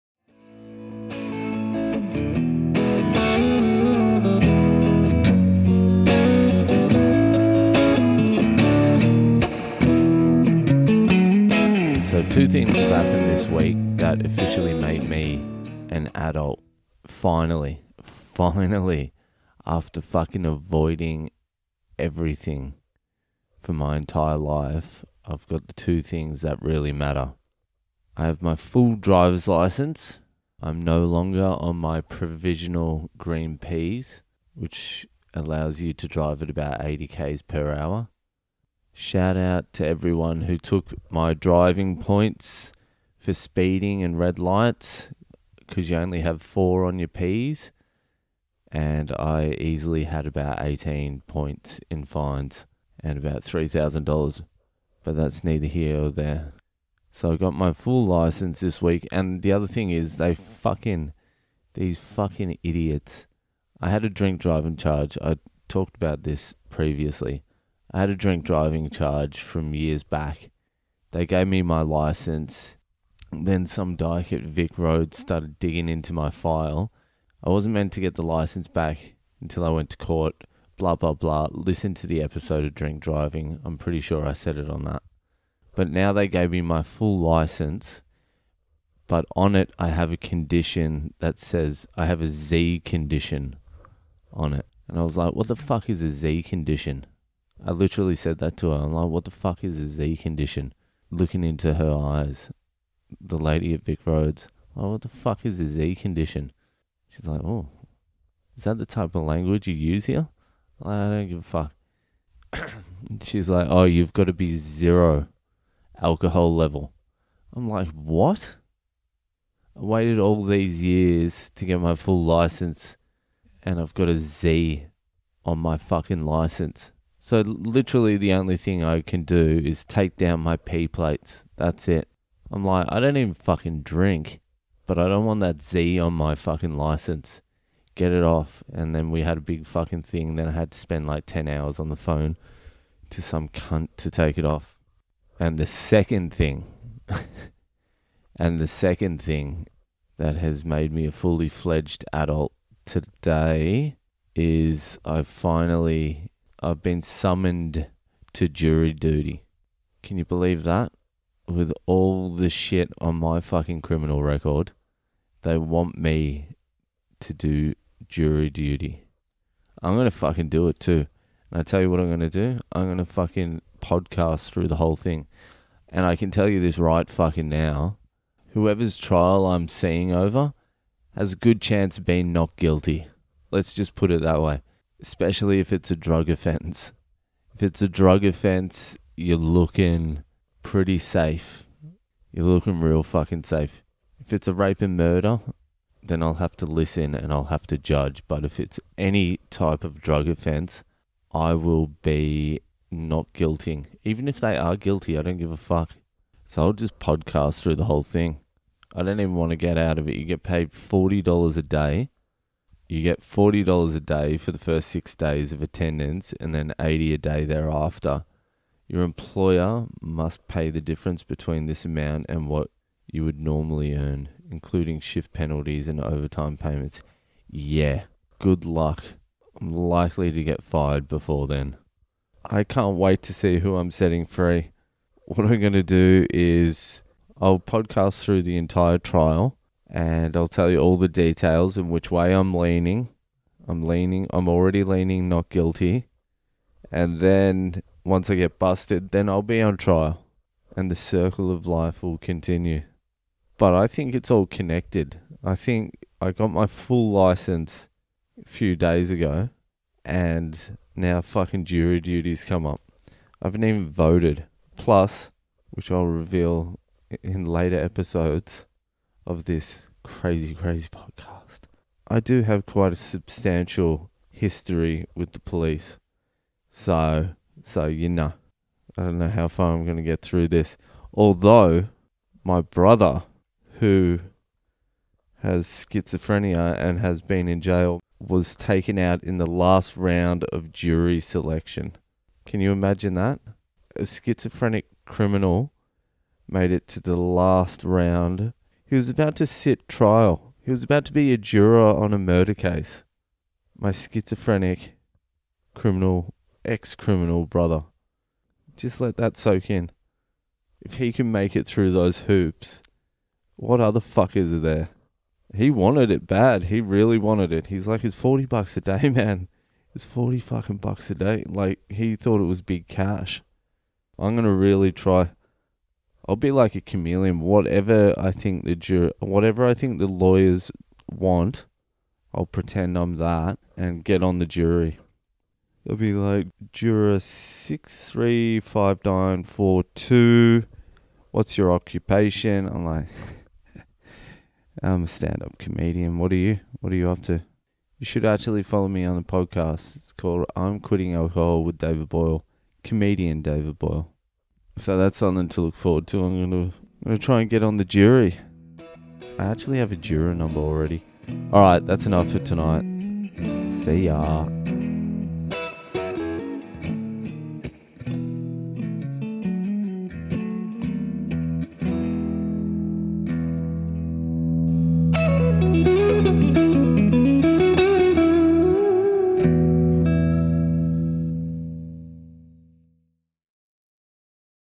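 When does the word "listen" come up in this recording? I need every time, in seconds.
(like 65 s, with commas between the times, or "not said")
81 s, 196 s.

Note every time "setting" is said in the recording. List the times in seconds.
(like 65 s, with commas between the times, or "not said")
233 s.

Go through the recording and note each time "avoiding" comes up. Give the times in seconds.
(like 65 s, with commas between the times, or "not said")
20 s.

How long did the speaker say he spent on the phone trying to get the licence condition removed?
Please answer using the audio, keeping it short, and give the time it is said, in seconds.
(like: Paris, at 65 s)
10 hours, at 141 s.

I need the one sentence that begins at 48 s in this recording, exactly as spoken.
And I easily had about 18 points in fines and about $3,000.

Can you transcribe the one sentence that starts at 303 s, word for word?
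My schizophrenic criminal, ex criminal brother.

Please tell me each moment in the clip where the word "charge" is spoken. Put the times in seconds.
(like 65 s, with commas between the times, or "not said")
64 s, 68 s.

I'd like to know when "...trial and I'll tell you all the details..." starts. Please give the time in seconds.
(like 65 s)
238 s.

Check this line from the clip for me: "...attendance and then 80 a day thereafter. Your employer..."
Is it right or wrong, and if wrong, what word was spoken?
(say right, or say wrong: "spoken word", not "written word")
right.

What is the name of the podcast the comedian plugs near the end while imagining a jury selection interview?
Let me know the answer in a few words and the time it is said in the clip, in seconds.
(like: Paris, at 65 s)
I'm Quitting Alcohol, at 350 s.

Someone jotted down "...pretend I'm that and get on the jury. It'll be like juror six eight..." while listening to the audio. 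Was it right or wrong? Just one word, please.
wrong.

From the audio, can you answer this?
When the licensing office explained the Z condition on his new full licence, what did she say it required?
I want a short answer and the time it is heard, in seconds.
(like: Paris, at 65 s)
Zero alcohol level, at 114 s.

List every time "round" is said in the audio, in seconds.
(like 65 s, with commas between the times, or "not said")
289 s, 297 s.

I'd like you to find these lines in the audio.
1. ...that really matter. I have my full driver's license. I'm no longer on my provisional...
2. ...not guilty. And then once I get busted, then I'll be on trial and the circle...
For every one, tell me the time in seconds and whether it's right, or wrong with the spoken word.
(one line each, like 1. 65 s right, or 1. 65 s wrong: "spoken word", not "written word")
1. 26 s right
2. 245 s right.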